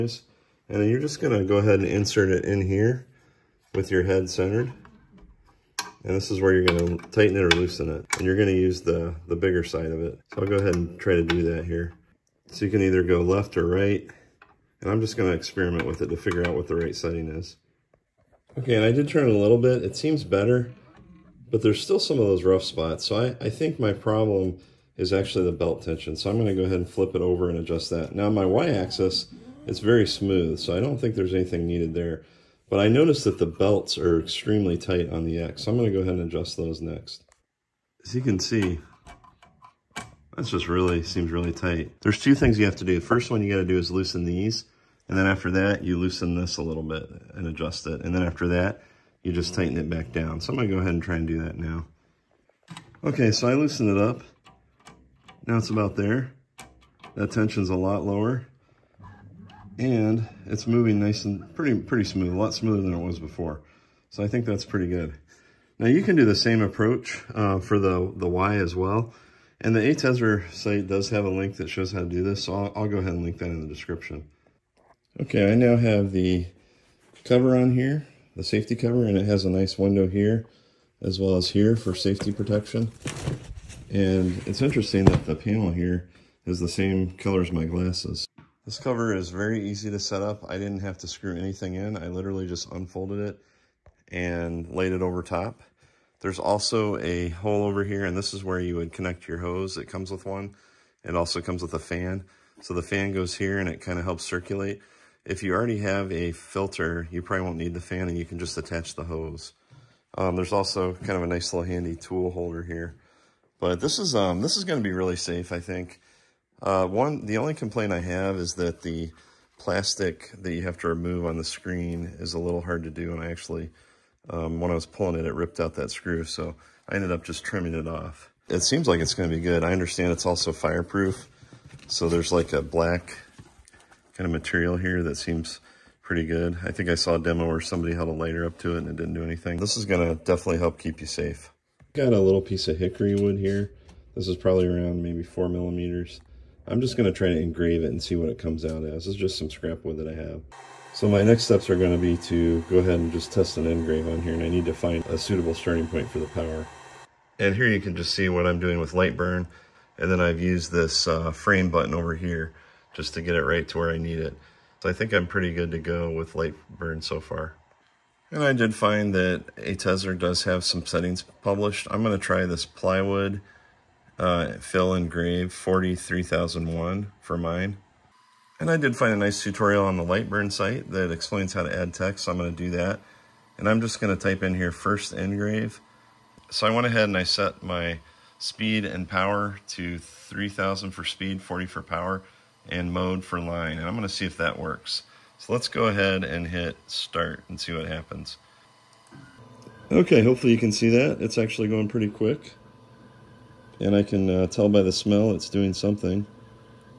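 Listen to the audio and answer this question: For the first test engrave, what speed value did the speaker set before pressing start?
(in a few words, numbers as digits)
3000.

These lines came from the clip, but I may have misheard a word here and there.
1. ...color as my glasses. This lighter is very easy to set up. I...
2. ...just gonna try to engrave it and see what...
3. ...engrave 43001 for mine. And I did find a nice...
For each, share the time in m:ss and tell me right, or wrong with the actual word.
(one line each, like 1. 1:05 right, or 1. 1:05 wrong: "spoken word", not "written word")
1. 1:27 wrong: "cover", not "lighter"
2. 2:26 right
3. 2:55 wrong: "grave", not "engrave".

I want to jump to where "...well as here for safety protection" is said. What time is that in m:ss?
1:21.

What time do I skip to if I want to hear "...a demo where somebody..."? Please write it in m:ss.
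2:17.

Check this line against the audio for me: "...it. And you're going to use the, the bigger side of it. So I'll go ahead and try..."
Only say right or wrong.
right.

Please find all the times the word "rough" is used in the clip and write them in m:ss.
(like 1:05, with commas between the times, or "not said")
0:22.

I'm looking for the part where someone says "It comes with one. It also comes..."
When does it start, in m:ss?
1:39.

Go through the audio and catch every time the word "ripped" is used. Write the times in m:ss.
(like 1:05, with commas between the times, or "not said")
2:05.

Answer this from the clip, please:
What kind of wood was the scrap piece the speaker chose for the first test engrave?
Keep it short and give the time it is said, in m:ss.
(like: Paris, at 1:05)
Hickory, at 2:22.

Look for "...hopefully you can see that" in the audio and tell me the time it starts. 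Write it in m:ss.
3:20.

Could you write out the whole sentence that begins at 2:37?
And here you can just see what I'm doing with LightBurn.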